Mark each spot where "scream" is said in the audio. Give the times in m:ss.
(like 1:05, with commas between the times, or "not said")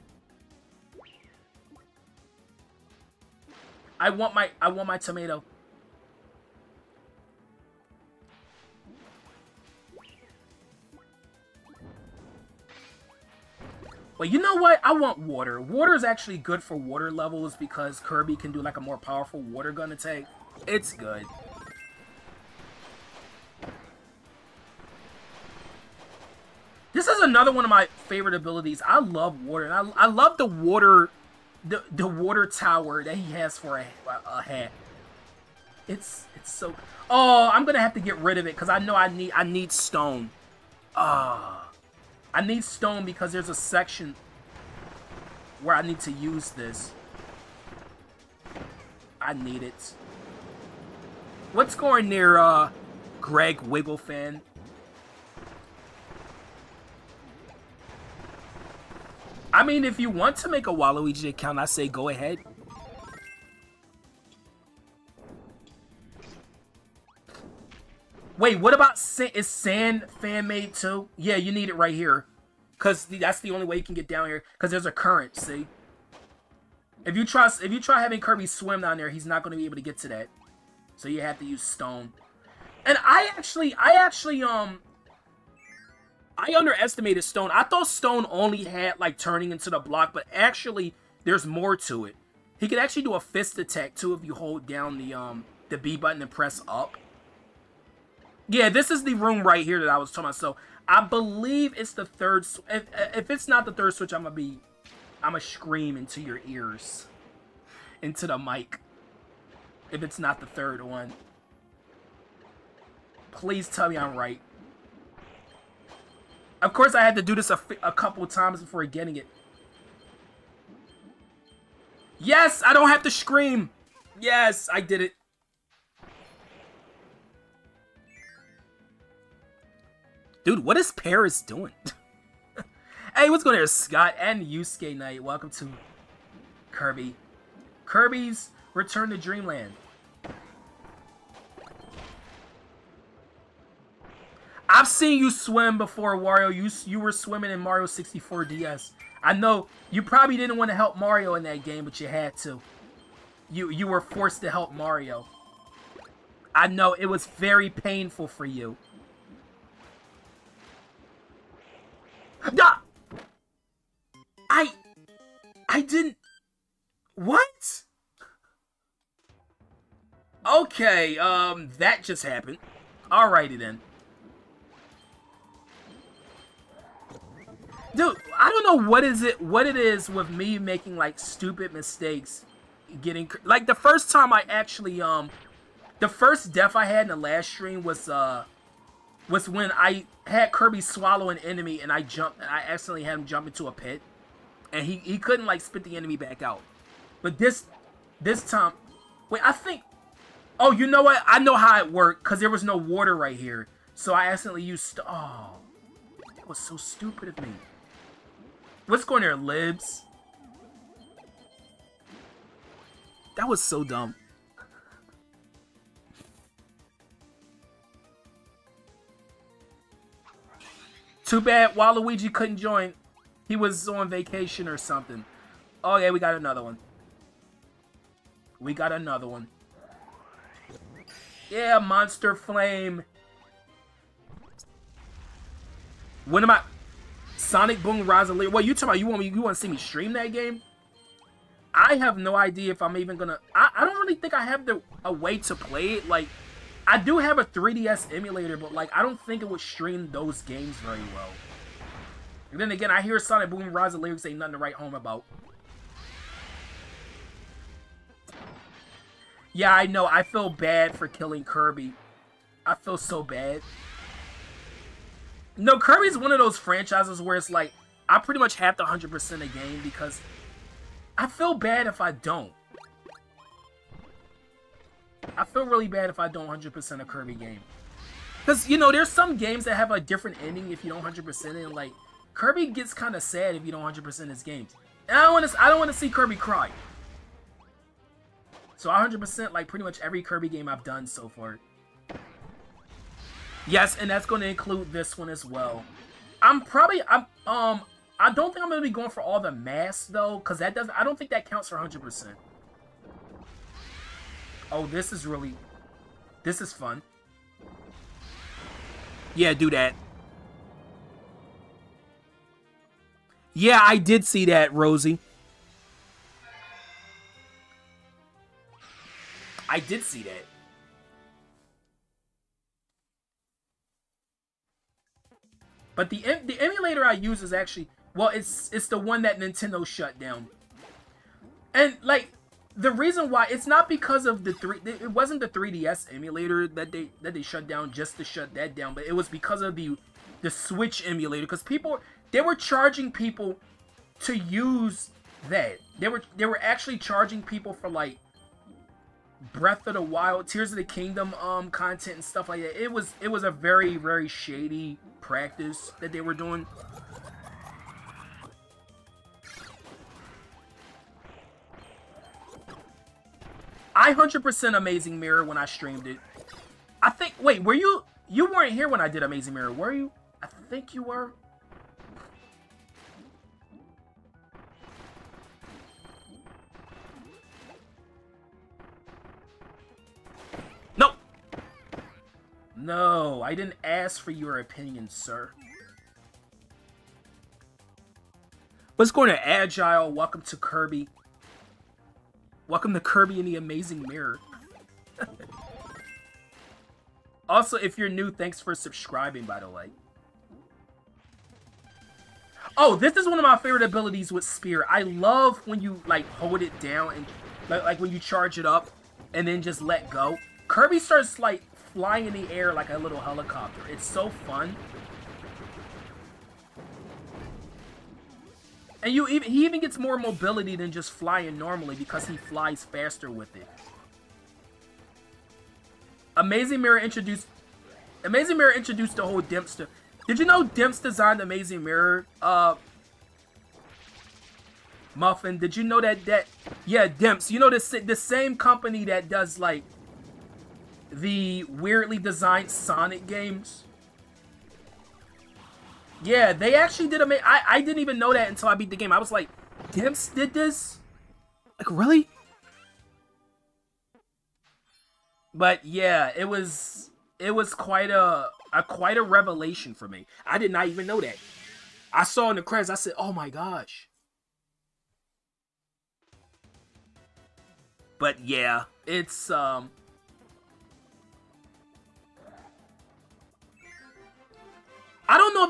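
1:45, 2:03.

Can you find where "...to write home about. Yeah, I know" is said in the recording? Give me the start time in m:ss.
4:14.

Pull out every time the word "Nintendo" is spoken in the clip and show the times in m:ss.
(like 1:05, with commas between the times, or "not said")
5:29.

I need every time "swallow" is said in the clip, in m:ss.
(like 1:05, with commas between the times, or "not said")
3:10.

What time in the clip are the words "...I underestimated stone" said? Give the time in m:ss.
1:26.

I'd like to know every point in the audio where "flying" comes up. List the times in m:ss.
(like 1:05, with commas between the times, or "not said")
6:51, 7:01.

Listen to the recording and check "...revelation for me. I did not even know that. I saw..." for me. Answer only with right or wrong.
right.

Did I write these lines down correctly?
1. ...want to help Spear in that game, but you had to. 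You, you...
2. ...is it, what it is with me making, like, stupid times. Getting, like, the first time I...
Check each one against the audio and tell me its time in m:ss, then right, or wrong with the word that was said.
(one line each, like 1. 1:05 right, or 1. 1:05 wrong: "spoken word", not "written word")
1. 2:30 wrong: "Mario", not "Spear"
2. 2:59 wrong: "mistakes", not "times".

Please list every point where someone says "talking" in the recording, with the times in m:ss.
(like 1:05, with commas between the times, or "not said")
1:40, 3:58.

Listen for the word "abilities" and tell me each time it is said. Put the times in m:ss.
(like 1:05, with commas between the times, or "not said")
0:28, 6:43.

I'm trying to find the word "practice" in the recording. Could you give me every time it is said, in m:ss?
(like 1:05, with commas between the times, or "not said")
5:55.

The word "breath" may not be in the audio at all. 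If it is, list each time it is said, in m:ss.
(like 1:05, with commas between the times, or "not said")
5:49.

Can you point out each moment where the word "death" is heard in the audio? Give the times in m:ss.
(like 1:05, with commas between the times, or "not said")
3:06.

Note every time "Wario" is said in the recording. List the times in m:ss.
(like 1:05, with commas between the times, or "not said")
2:26.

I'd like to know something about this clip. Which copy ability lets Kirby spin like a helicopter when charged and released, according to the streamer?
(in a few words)
Spear.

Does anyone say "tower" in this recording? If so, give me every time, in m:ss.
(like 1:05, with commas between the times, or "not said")
0:32.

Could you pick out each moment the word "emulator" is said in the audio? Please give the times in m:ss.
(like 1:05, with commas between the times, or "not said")
4:08, 5:26, 5:36, 5:41.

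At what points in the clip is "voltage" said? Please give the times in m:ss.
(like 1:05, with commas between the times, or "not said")
not said.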